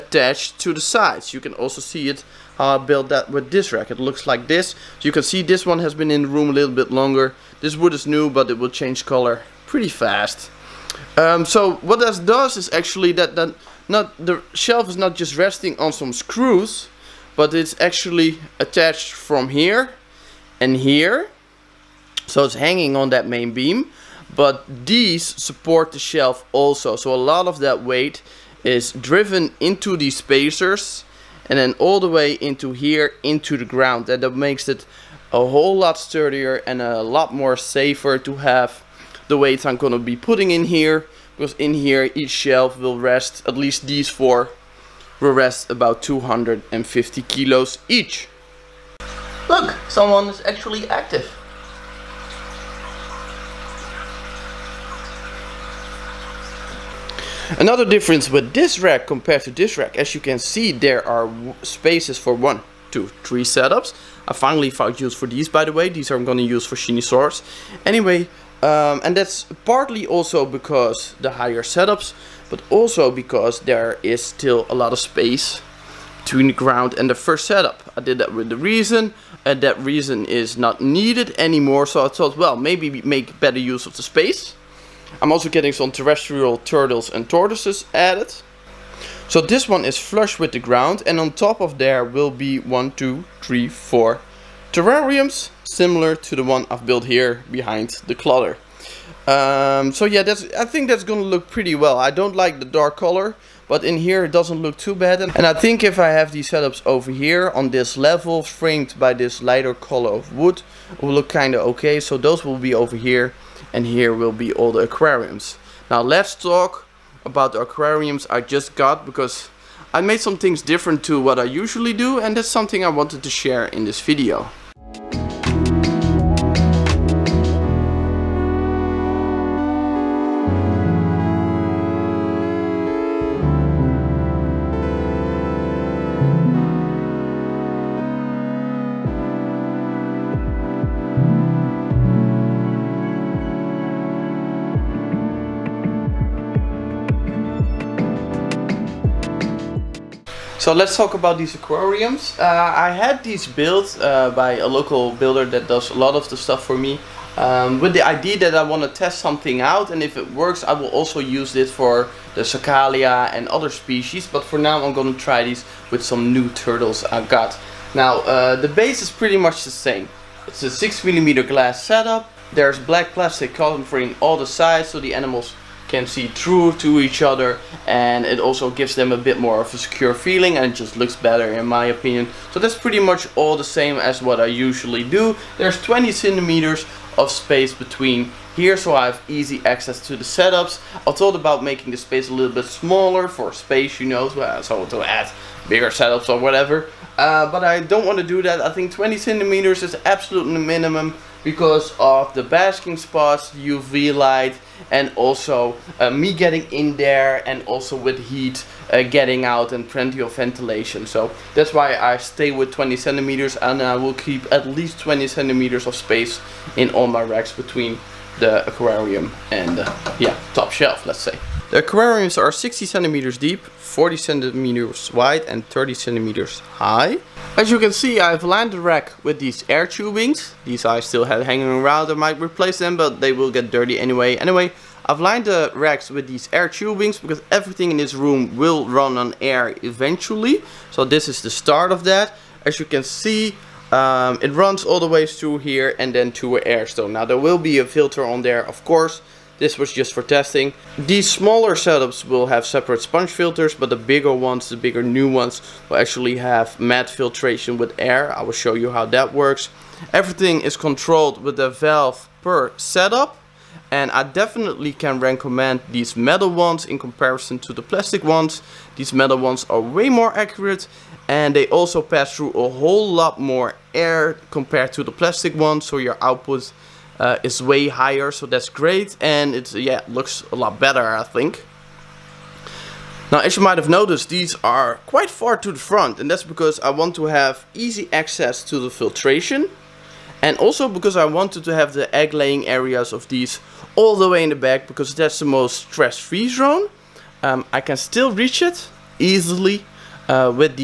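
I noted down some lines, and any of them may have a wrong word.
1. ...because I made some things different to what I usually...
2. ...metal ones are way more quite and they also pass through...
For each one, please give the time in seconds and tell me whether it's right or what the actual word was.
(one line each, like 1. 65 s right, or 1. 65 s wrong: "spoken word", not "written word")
1. 119 s right
2. 269 s wrong: "accurate", not "quite".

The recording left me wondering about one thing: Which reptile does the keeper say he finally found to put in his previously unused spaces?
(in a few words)
Shinisaurus.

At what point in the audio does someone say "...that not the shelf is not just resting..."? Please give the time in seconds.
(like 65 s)
13 s.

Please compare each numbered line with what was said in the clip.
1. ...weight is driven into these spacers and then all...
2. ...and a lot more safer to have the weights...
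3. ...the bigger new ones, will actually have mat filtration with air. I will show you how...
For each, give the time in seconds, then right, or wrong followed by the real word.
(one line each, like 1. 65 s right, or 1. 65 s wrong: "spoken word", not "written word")
1. 27 s right
2. 36 s right
3. 254 s right.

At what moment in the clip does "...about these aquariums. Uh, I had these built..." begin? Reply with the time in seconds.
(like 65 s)
151 s.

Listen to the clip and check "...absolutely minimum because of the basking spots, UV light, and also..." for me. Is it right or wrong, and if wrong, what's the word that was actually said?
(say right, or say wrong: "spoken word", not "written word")
right.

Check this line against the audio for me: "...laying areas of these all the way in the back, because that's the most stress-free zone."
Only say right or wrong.
right.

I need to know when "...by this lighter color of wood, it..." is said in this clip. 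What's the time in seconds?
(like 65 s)
108 s.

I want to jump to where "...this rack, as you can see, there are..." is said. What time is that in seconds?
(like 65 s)
59 s.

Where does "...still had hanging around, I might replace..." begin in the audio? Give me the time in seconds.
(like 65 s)
230 s.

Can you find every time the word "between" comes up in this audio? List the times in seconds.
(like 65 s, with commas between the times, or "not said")
76 s, 187 s, 217 s.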